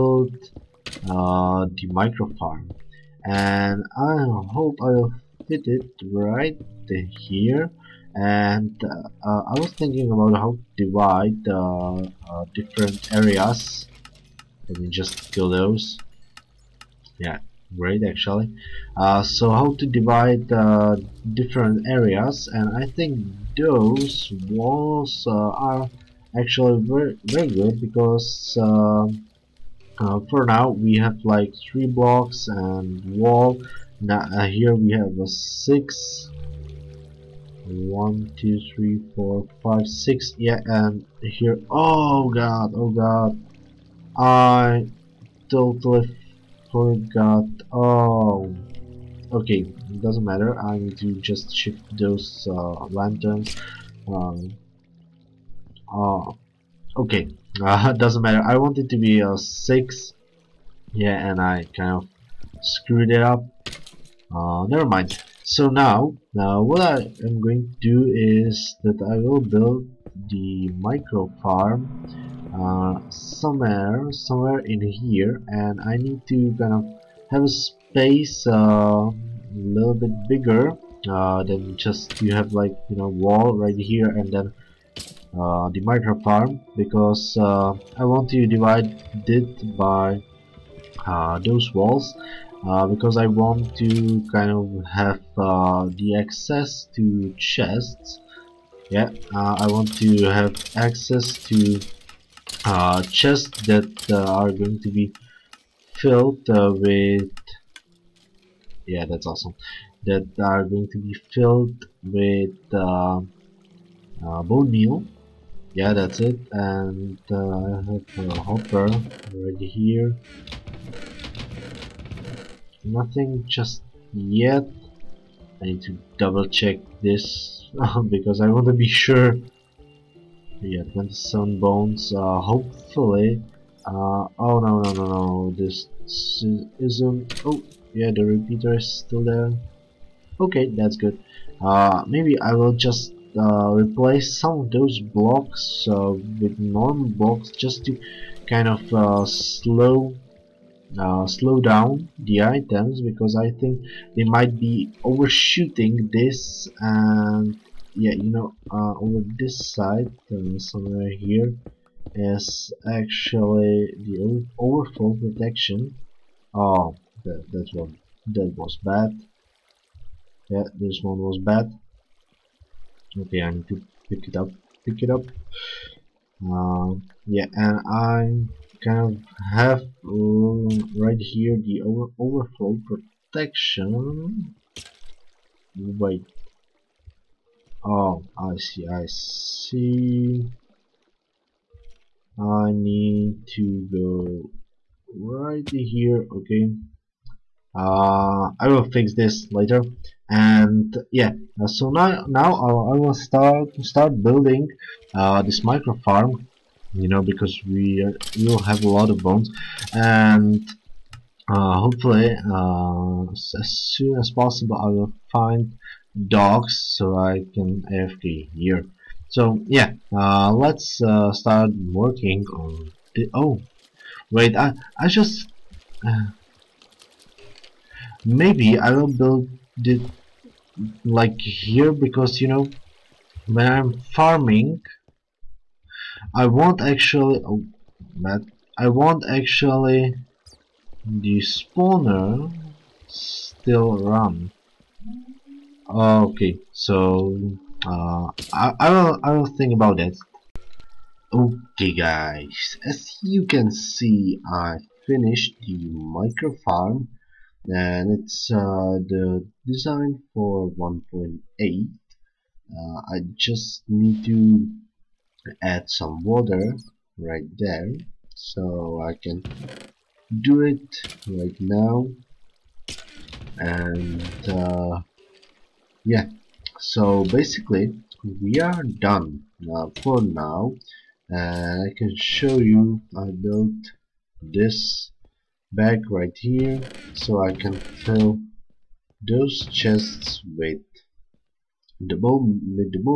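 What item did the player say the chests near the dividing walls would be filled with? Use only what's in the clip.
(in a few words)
bone meal.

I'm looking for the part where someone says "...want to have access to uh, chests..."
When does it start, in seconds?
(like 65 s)
99 s.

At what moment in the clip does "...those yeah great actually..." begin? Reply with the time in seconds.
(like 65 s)
15 s.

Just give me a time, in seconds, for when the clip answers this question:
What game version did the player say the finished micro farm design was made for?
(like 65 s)
260 s.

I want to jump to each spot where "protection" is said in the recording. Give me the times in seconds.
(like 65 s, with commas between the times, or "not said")
165 s, 182 s.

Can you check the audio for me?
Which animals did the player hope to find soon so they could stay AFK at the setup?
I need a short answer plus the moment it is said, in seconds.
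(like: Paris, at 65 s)
dogs, at 216 s.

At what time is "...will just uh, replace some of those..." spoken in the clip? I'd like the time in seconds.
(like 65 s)
142 s.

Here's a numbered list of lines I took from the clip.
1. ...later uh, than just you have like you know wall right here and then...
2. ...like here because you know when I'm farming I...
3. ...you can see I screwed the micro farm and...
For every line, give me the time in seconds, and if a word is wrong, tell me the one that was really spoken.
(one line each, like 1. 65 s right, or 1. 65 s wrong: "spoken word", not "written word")
1. 80 s wrong: "bigger", not "later"
2. 231 s right
3. 253 s wrong: "finished", not "screwed".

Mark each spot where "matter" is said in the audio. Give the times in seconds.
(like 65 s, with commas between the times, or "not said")
50 s, 58 s.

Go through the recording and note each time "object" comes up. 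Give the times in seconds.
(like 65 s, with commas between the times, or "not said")
not said.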